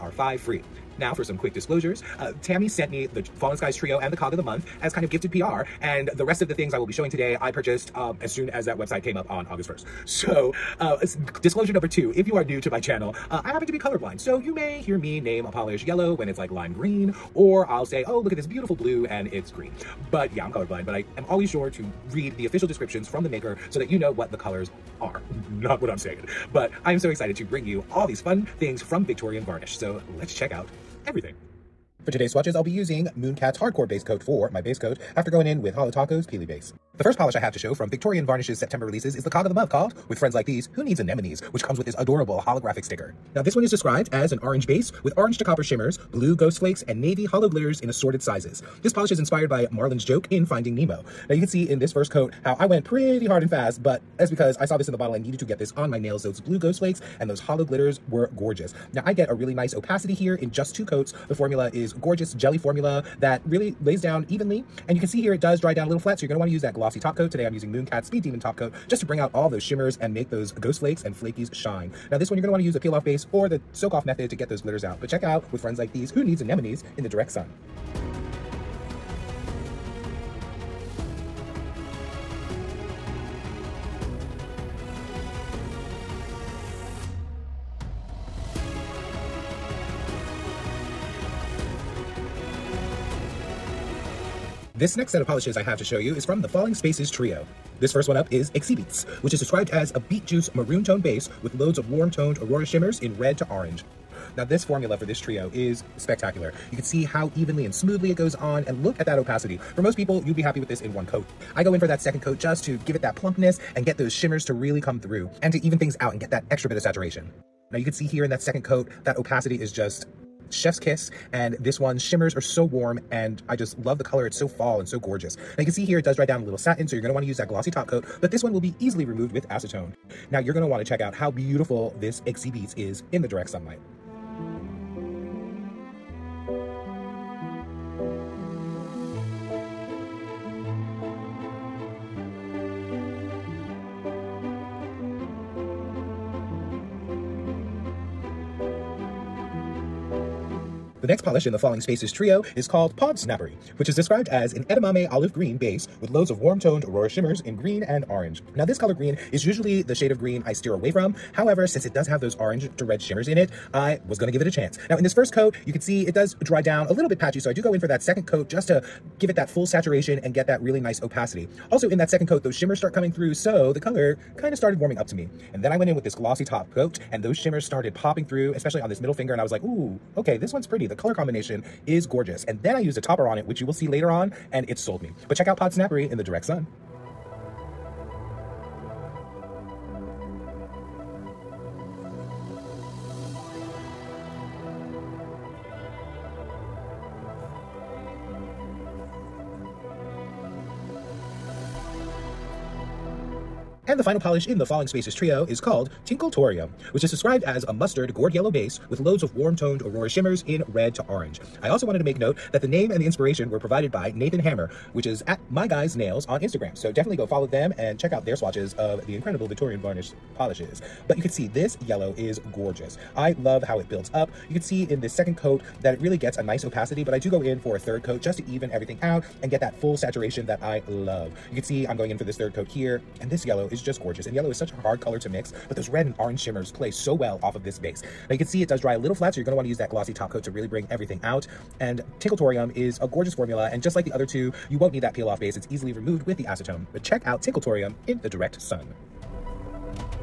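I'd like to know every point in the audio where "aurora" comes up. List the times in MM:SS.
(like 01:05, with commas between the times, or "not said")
01:42, 02:36, 03:29.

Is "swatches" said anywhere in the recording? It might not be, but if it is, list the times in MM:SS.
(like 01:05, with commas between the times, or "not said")
00:32, 03:38.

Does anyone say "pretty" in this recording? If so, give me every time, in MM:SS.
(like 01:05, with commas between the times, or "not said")
00:52, 03:00.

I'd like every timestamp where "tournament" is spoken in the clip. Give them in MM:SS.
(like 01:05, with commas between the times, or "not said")
not said.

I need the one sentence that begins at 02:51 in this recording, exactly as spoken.
Also in that second coat, those shimmers start coming through, so the color kind of started warming up to me.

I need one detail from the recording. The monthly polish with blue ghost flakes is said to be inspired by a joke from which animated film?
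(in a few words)
Finding Nemo.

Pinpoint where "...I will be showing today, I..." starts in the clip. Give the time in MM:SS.
00:06.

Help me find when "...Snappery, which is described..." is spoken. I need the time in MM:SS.
02:33.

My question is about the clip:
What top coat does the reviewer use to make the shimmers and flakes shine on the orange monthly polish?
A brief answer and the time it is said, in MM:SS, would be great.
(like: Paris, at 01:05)
Mooncat Speed Demon Top Coat, at 01:07.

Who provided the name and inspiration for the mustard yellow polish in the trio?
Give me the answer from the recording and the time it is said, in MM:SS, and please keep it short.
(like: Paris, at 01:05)
Nathan Hammer, at 03:34.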